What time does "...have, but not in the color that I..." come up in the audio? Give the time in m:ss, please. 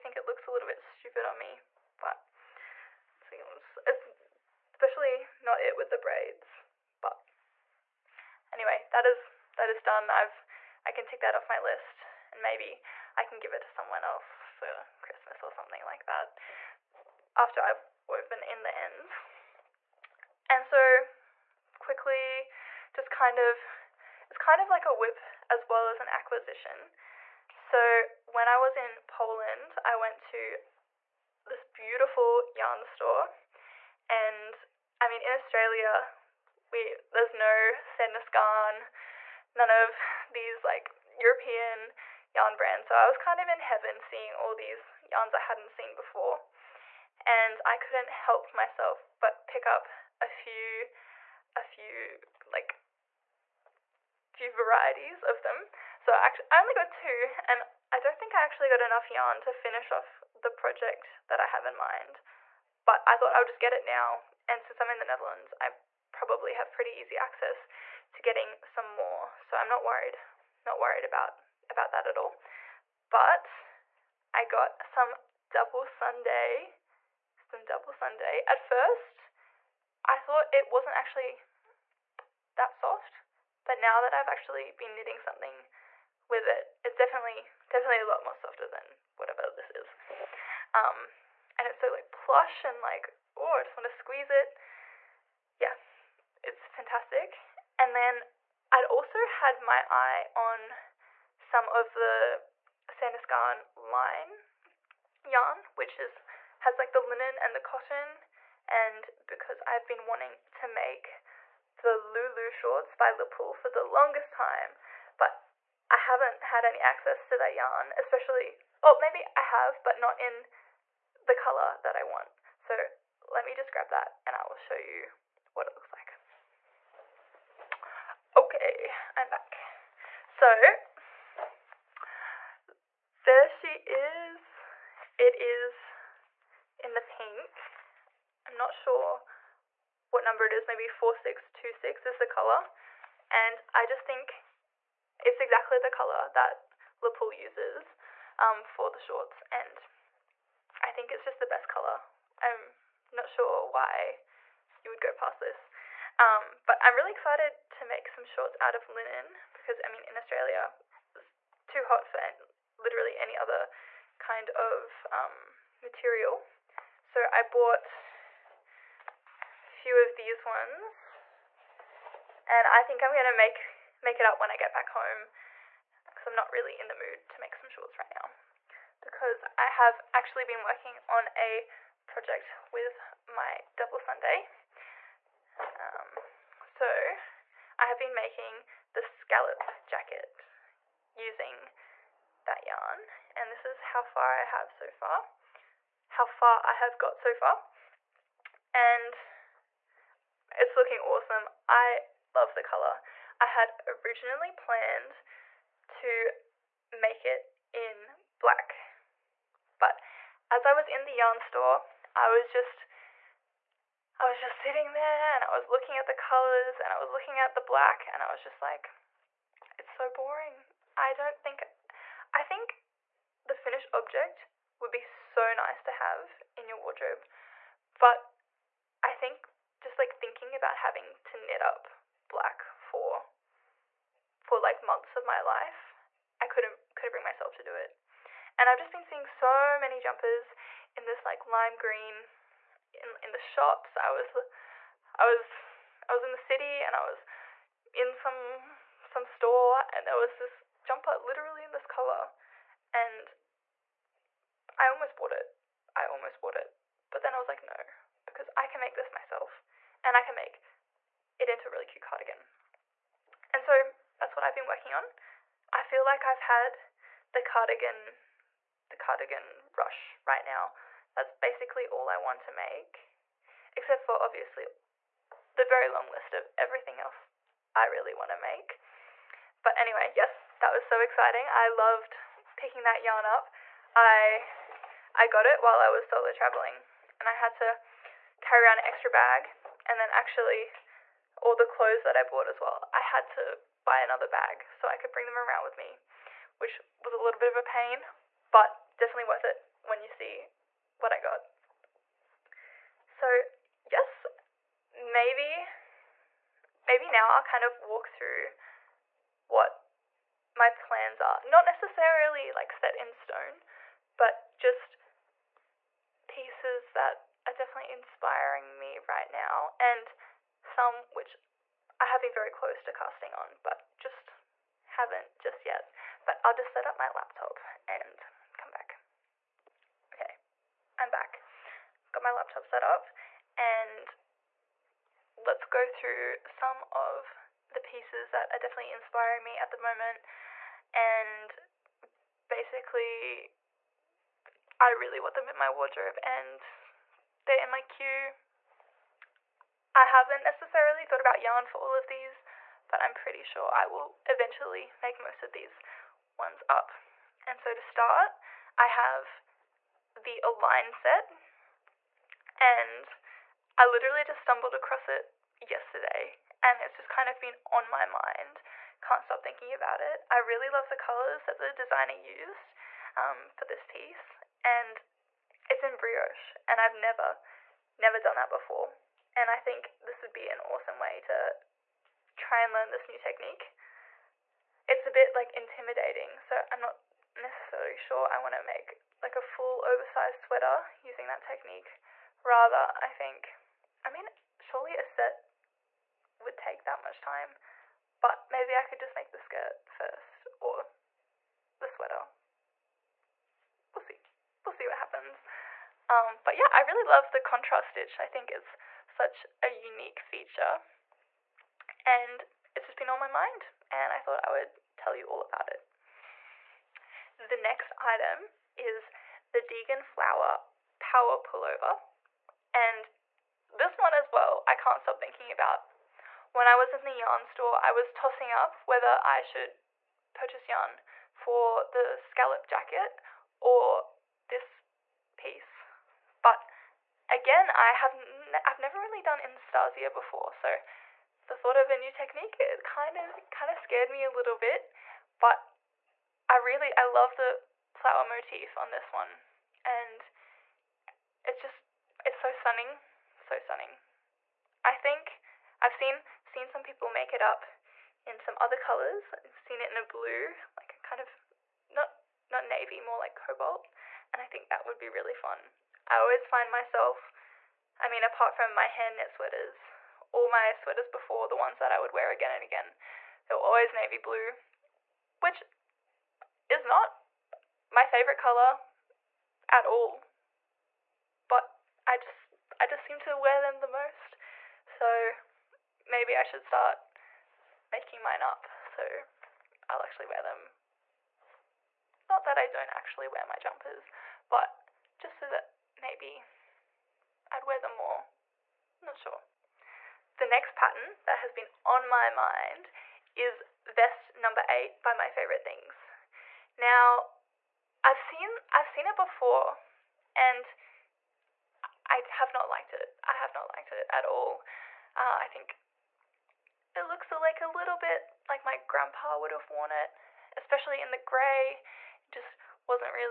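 1:59.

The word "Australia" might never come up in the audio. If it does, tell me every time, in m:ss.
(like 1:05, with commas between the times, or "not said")
0:35, 2:40.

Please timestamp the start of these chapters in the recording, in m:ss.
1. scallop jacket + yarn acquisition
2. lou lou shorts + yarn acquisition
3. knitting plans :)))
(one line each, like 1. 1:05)
1. 0:25
2. 1:52
3. 5:10.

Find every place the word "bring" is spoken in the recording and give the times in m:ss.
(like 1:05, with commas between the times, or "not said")
3:57, 4:55.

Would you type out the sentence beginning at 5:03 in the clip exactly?
So yes, maybe, maybe now I'll kind of walk through what my plans are.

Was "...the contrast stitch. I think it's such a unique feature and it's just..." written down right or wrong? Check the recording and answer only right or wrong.
right.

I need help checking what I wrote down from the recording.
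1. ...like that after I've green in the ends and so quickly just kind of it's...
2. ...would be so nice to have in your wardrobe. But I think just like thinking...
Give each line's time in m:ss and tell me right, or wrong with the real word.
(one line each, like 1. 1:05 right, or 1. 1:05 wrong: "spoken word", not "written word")
1. 0:15 wrong: "woven", not "green"
2. 3:44 right.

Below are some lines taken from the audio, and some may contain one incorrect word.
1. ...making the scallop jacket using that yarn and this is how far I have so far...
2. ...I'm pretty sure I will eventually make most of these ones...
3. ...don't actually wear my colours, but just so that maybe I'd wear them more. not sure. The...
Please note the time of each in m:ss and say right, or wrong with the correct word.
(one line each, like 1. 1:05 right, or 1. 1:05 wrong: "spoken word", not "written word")
1. 3:08 right
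2. 5:53 right
3. 8:12 wrong: "jumpers", not "colours".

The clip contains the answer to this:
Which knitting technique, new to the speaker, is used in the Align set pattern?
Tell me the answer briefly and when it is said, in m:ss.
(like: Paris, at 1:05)
Brioche, at 6:15.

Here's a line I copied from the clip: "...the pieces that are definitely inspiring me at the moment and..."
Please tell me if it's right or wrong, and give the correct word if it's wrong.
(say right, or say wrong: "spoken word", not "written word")
right.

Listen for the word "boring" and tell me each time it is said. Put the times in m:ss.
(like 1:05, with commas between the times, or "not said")
3:40.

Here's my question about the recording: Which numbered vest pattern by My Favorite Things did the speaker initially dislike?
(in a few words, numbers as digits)
8.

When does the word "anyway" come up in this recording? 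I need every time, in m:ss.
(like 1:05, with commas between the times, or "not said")
0:08, 4:39.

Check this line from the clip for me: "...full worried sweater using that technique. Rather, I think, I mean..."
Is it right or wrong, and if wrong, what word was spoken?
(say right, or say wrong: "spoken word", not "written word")
wrong: "oversized", not "worried".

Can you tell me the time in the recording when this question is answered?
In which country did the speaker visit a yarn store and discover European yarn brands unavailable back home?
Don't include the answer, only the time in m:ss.
0:29.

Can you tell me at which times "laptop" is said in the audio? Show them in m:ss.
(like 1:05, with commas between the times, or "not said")
5:27, 5:32.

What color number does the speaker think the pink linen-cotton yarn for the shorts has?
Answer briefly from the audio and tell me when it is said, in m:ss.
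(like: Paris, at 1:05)
4626, at 2:20.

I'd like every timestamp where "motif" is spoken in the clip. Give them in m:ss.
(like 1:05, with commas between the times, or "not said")
7:28.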